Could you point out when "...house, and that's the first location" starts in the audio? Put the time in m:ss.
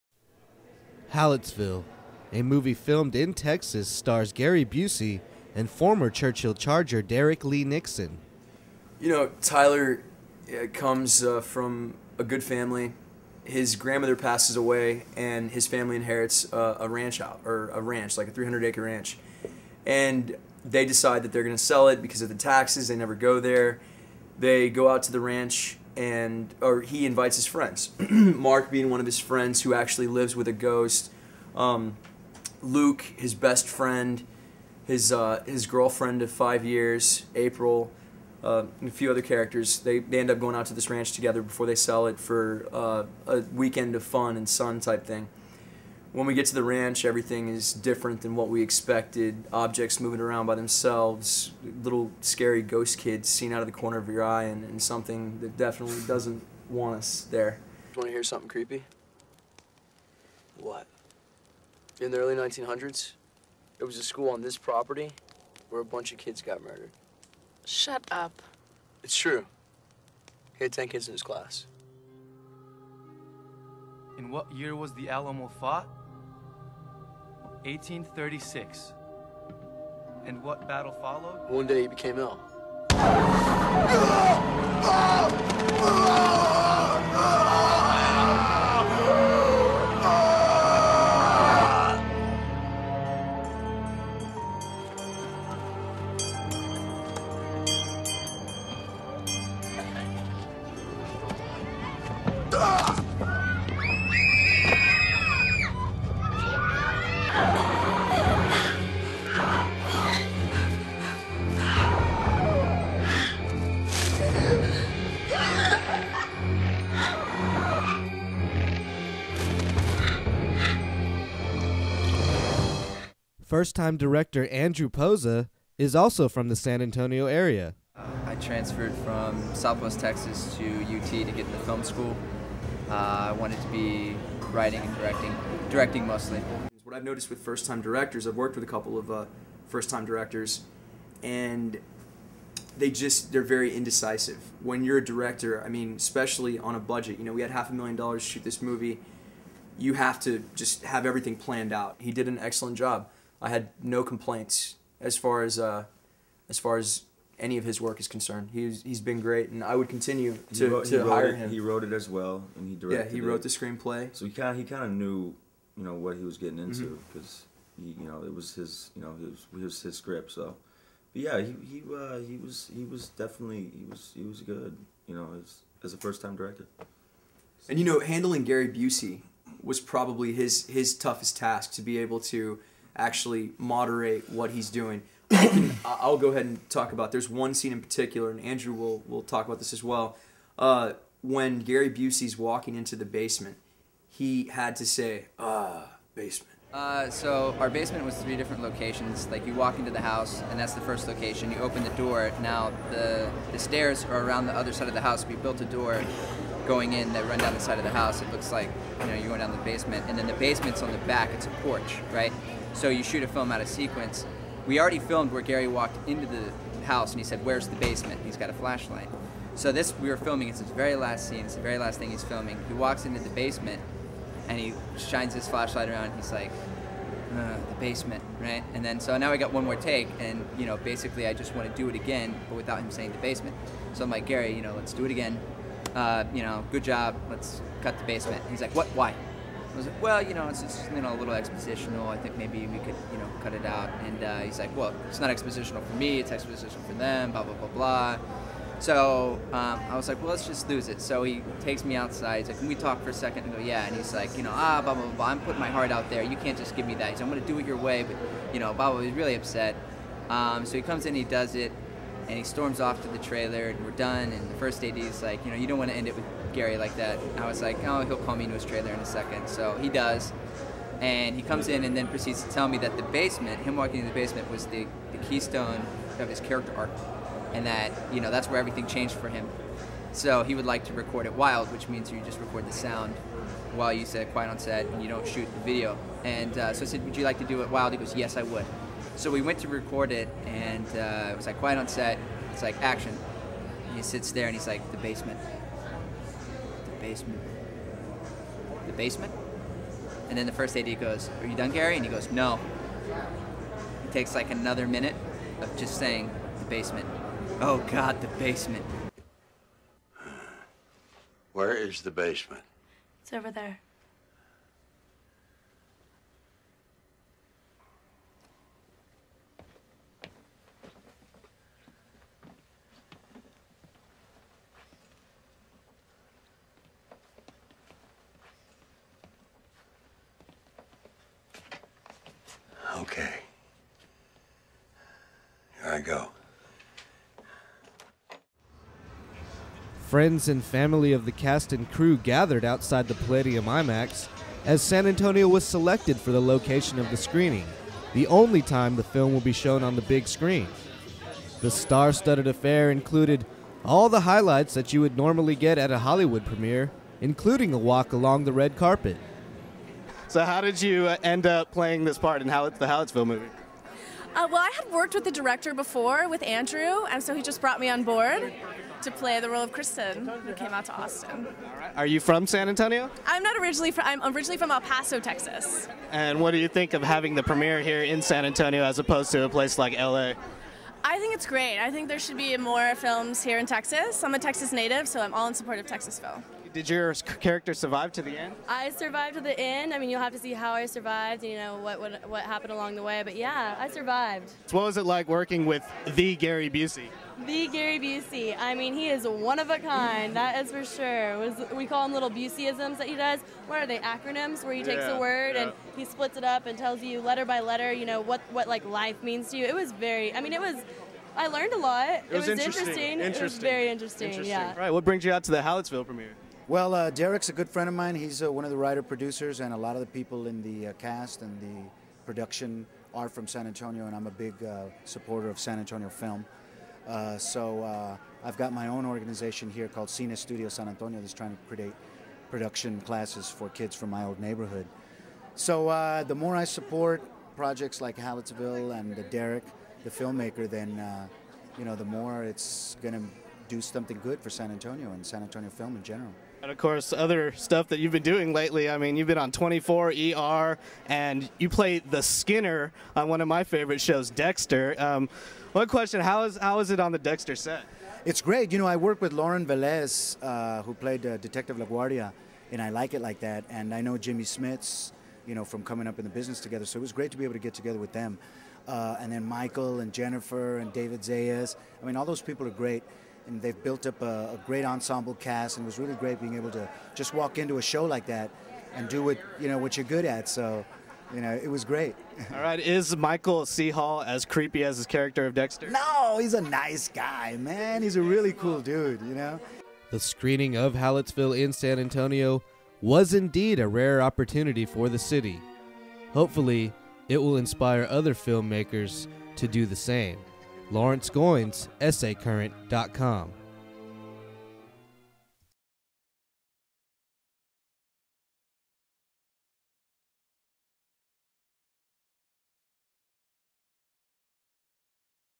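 3:20.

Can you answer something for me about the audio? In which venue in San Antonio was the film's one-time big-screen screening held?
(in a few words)
Palladium IMAX.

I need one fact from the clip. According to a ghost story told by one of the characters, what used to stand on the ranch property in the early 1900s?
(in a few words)
a school.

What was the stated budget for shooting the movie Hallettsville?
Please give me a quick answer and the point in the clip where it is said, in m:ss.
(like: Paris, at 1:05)
half a million dollars, at 2:27.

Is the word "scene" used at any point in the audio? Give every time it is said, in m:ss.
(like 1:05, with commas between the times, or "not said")
3:07, 3:41.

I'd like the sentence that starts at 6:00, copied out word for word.
So how did you uh, end up playing this part in how the Hallettsville movie?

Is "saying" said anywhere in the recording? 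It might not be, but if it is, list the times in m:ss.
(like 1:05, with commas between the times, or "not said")
3:52, 5:05.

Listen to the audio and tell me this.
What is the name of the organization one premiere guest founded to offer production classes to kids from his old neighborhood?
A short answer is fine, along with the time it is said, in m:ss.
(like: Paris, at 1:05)
Cine Studio San Antonio, at 7:10.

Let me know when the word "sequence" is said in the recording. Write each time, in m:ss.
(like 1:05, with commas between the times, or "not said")
3:33.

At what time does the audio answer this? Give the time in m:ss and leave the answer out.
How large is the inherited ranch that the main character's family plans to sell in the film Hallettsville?
0:18.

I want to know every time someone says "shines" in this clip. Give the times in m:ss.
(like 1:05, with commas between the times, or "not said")
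3:45.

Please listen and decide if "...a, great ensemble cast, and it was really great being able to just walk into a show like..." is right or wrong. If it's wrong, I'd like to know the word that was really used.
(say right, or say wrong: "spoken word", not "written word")
right.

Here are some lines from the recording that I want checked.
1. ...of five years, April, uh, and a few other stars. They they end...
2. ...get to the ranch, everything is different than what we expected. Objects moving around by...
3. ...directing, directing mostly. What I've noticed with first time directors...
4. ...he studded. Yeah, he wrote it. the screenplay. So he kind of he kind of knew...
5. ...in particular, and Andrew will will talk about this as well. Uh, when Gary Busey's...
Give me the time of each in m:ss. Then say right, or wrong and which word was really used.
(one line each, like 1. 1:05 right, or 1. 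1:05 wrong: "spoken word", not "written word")
1. 0:36 wrong: "characters", not "stars"
2. 0:46 right
3. 2:14 right
4. 2:42 wrong: "directed", not "studded"
5. 3:07 right.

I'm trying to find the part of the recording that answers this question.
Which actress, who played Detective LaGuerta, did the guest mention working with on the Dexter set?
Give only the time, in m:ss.
7:39.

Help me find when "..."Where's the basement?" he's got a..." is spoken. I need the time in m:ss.
3:37.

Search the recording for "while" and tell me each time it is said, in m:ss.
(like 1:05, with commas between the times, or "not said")
4:43.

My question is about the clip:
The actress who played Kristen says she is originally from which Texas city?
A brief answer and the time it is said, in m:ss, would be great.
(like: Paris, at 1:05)
El Paso, at 6:14.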